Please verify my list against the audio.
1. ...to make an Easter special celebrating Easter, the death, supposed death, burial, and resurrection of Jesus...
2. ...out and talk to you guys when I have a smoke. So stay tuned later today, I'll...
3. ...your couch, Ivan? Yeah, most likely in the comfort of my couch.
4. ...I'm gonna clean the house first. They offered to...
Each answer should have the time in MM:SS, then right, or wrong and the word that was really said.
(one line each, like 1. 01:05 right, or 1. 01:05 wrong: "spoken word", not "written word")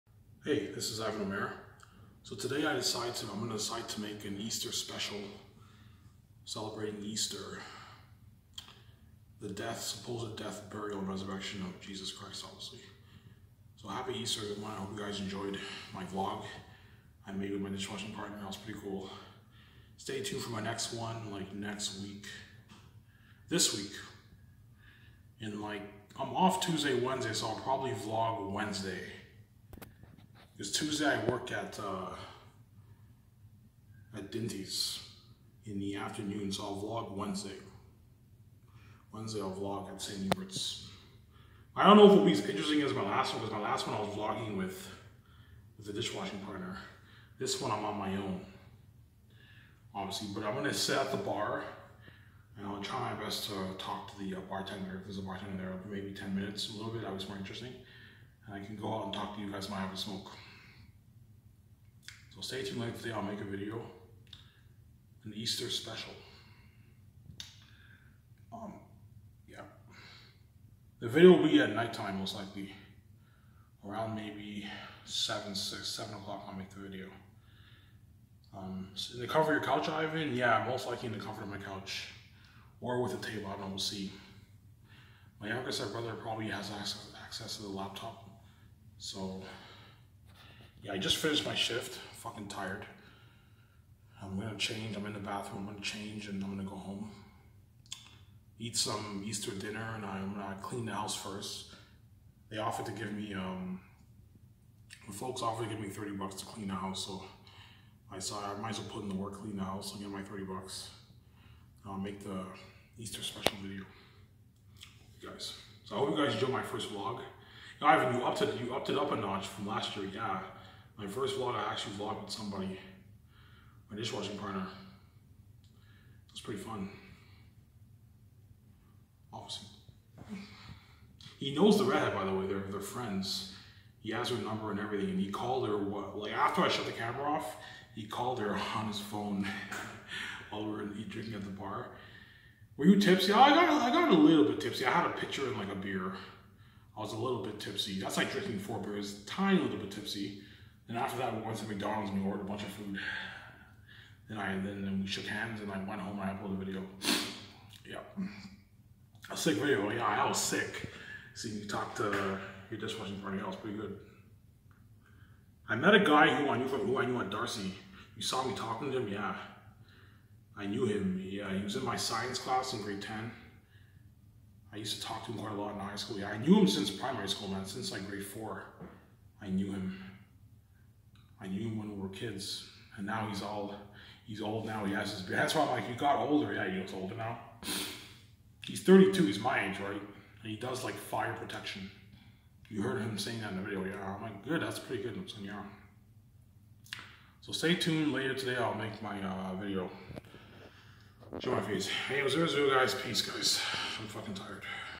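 1. 00:03 right
2. 00:58 right
3. 01:19 right
4. 01:40 right.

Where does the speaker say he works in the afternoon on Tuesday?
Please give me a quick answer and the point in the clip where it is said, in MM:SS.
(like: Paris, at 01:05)
Dinty's, at 00:34.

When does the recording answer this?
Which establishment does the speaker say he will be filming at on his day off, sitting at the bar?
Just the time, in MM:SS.
00:39.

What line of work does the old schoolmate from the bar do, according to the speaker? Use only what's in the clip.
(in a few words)
Fire protection.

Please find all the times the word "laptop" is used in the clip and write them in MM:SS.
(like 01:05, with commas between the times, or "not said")
01:27.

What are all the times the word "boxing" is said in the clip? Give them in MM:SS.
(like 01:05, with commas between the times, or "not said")
not said.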